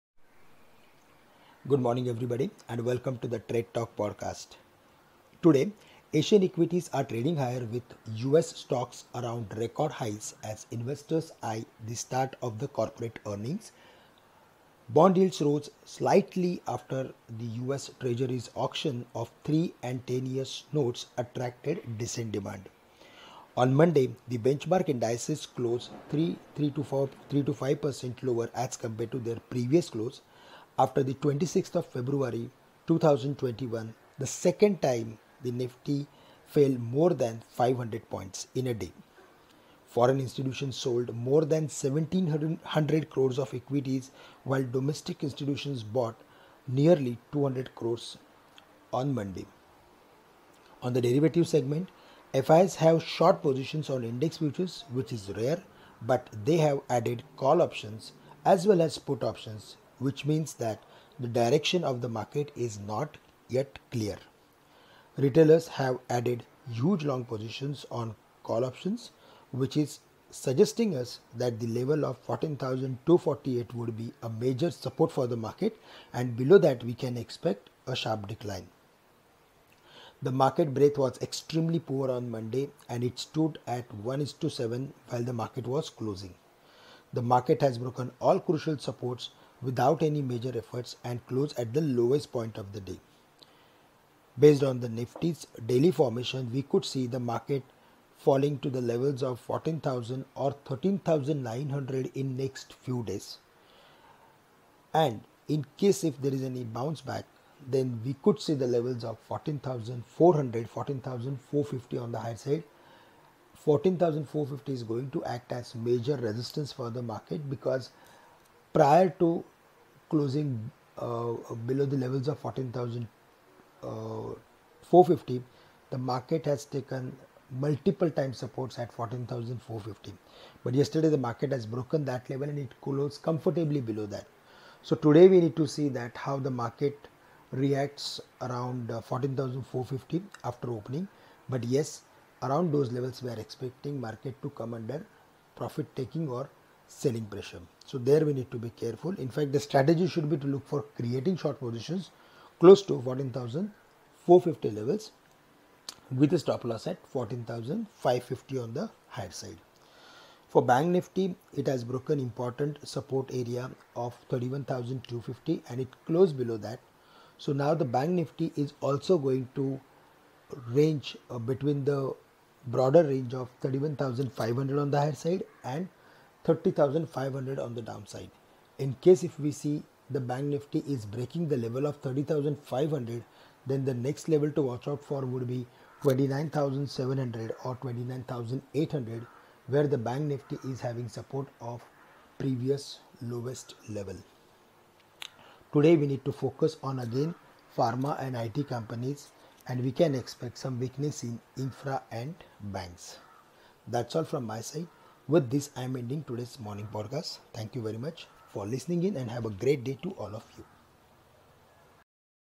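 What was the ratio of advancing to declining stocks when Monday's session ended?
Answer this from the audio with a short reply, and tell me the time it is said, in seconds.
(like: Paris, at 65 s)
1 is to 7, at 83 s.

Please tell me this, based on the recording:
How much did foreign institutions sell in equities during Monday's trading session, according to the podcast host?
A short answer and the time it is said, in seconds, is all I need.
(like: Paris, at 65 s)
more than 1700 crores, at 41 s.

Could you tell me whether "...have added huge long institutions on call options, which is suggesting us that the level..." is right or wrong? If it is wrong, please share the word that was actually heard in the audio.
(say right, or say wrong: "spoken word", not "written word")
wrong: "positions", not "institutions".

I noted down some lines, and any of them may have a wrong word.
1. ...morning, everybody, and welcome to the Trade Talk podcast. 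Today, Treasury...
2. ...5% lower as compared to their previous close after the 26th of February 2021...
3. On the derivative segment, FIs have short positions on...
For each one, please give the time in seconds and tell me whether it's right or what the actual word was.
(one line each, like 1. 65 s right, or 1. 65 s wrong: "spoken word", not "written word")
1. 1 s wrong: "Asian", not "Treasury"
2. 27 s right
3. 50 s right.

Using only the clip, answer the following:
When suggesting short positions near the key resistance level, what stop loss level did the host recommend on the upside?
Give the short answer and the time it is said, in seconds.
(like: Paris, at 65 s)
14,550, at 157 s.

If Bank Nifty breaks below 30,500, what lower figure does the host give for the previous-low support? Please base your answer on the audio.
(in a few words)
29,700.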